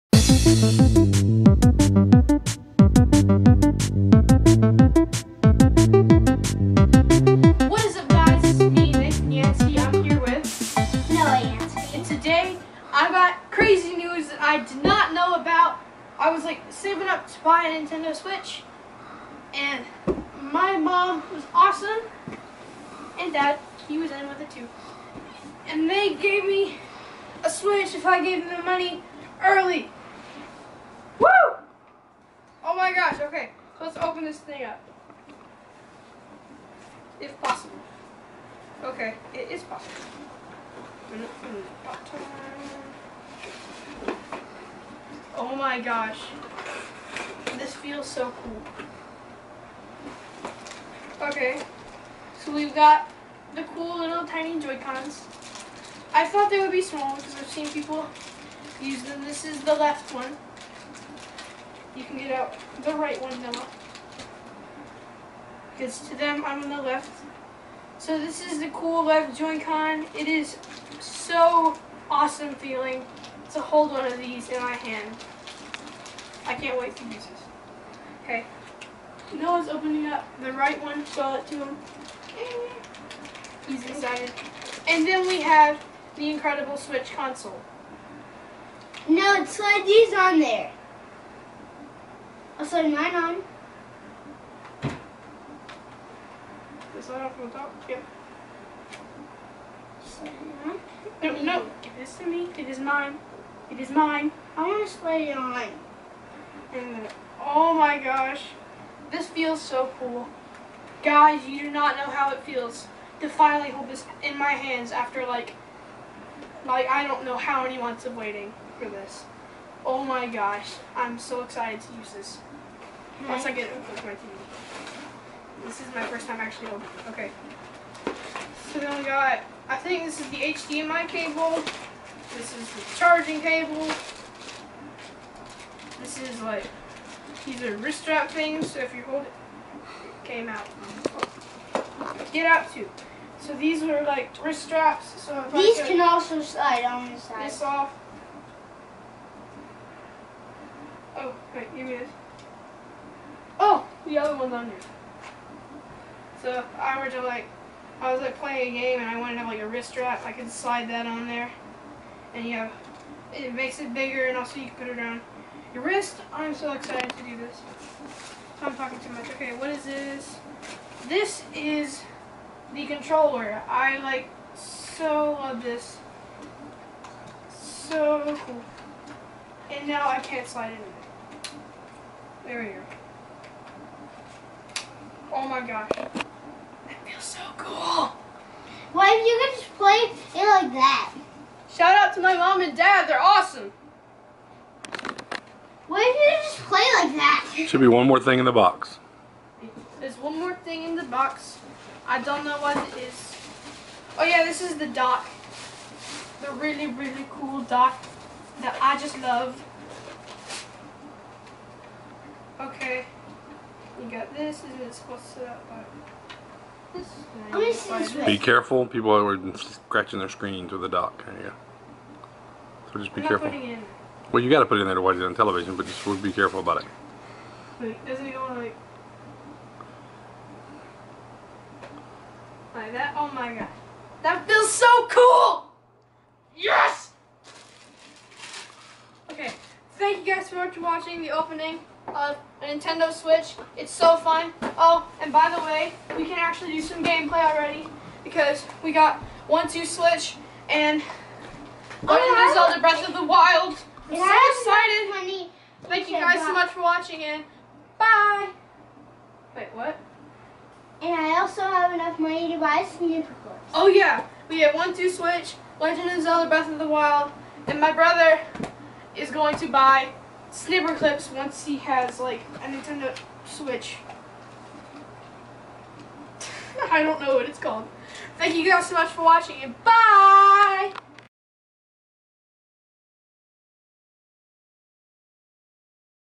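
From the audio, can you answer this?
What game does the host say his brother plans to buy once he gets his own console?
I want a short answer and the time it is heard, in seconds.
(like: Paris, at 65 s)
Snipperclips, at 270 s.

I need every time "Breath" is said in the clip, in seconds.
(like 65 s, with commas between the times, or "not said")
252 s, 266 s.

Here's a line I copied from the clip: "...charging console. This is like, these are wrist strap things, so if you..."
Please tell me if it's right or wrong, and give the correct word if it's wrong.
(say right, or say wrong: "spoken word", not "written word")
wrong: "cable", not "console".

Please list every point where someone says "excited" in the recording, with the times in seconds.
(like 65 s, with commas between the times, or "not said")
83 s, 121 s, 166 s, 254 s.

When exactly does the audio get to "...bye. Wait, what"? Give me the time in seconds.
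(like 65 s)
257 s.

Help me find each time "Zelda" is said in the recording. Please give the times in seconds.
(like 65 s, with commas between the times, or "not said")
252 s, 266 s.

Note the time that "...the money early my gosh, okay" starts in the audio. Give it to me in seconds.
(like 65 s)
28 s.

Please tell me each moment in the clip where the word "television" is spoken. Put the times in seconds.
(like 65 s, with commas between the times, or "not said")
225 s.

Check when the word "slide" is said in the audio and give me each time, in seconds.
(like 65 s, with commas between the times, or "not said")
89 s, 146 s, 160 s, 180 s.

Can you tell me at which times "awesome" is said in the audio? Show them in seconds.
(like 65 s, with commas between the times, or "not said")
21 s, 72 s, 193 s.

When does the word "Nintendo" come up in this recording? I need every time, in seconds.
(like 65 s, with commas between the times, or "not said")
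17 s, 242 s, 272 s.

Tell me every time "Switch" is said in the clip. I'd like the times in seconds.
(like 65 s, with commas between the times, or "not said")
18 s, 27 s, 86 s, 243 s, 249 s, 265 s, 273 s.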